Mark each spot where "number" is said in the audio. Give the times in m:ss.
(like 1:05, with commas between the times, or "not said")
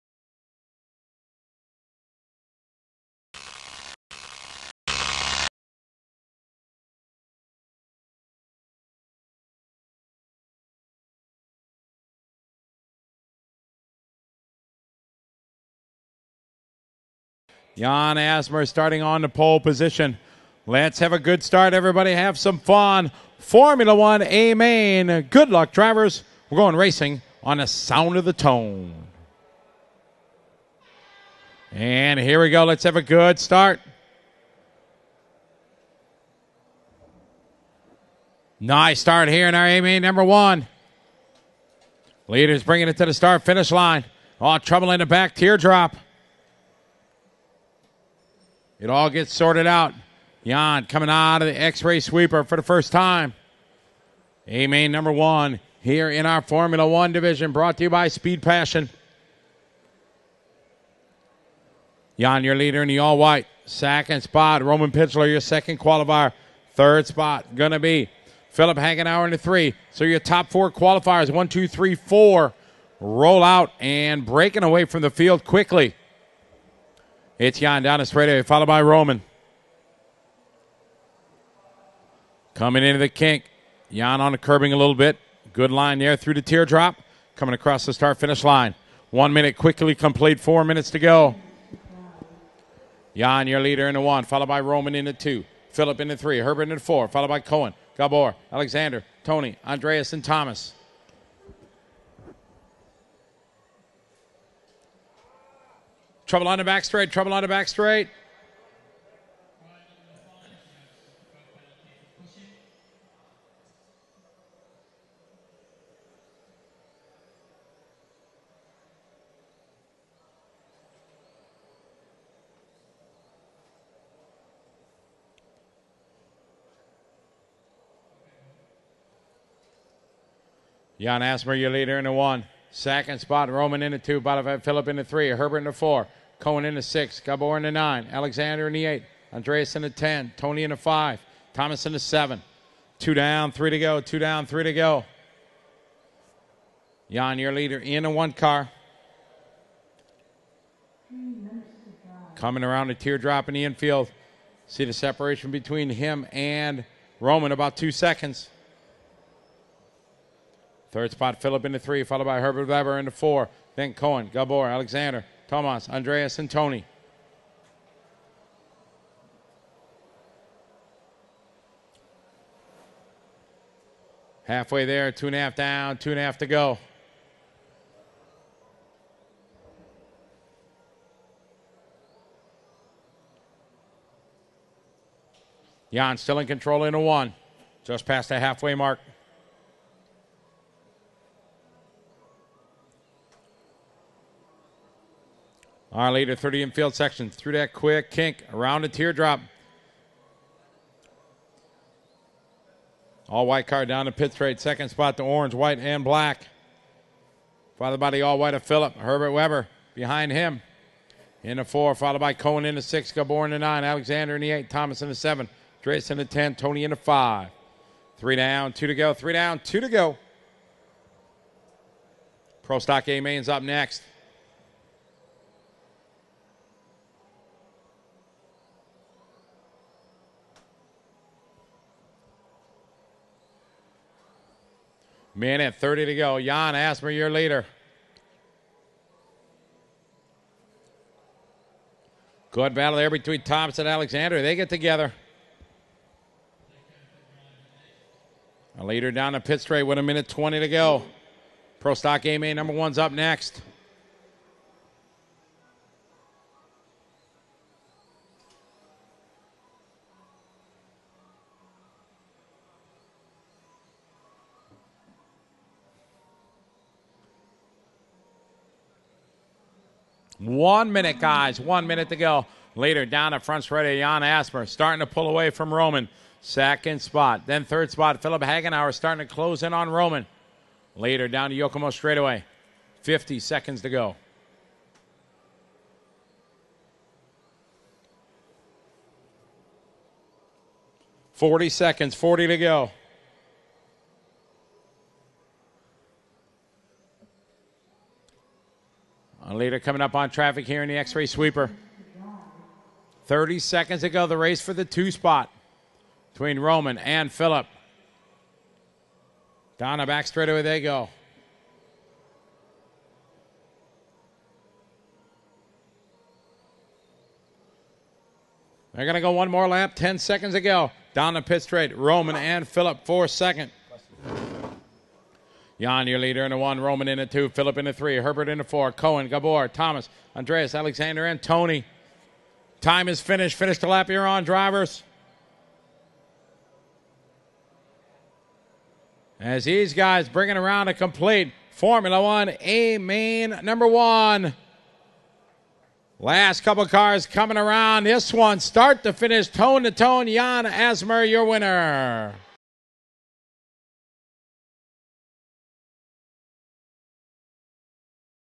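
0:40, 0:54, 4:12, 5:43.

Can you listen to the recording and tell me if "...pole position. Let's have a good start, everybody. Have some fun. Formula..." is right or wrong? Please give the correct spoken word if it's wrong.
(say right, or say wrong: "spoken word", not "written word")
right.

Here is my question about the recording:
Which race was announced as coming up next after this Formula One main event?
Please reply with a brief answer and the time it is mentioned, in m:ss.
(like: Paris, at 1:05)
Pro Stock A Main, at 3:42.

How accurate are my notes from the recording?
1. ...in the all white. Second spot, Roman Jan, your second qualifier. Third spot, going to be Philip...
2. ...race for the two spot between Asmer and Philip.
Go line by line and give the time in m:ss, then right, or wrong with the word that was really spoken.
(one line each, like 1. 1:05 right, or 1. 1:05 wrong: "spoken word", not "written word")
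1. 1:02 wrong: "Pichler", not "Jan"
2. 5:04 wrong: "Roman", not "Asmer".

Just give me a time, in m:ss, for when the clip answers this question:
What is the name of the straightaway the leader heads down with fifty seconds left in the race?
4:41.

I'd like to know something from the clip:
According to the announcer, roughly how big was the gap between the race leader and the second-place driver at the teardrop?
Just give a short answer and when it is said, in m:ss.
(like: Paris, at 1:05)
about 2 seconds, at 2:37.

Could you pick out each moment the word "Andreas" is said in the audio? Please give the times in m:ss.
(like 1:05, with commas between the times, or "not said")
1:39, 2:19, 2:45, 5:30.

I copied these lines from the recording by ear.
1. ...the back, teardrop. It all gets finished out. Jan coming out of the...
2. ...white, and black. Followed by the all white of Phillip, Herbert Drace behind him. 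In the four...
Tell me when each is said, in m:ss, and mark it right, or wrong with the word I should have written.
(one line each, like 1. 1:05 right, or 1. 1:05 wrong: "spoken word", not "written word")
1. 0:44 wrong: "sorted", not "finished"
2. 3:25 wrong: "Weber", not "Drace".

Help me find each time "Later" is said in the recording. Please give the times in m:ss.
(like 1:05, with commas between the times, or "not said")
4:32, 4:40.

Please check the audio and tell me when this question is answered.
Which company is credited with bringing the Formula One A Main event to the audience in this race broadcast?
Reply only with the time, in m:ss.
0:58.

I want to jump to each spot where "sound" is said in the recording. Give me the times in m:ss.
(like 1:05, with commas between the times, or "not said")
0:27.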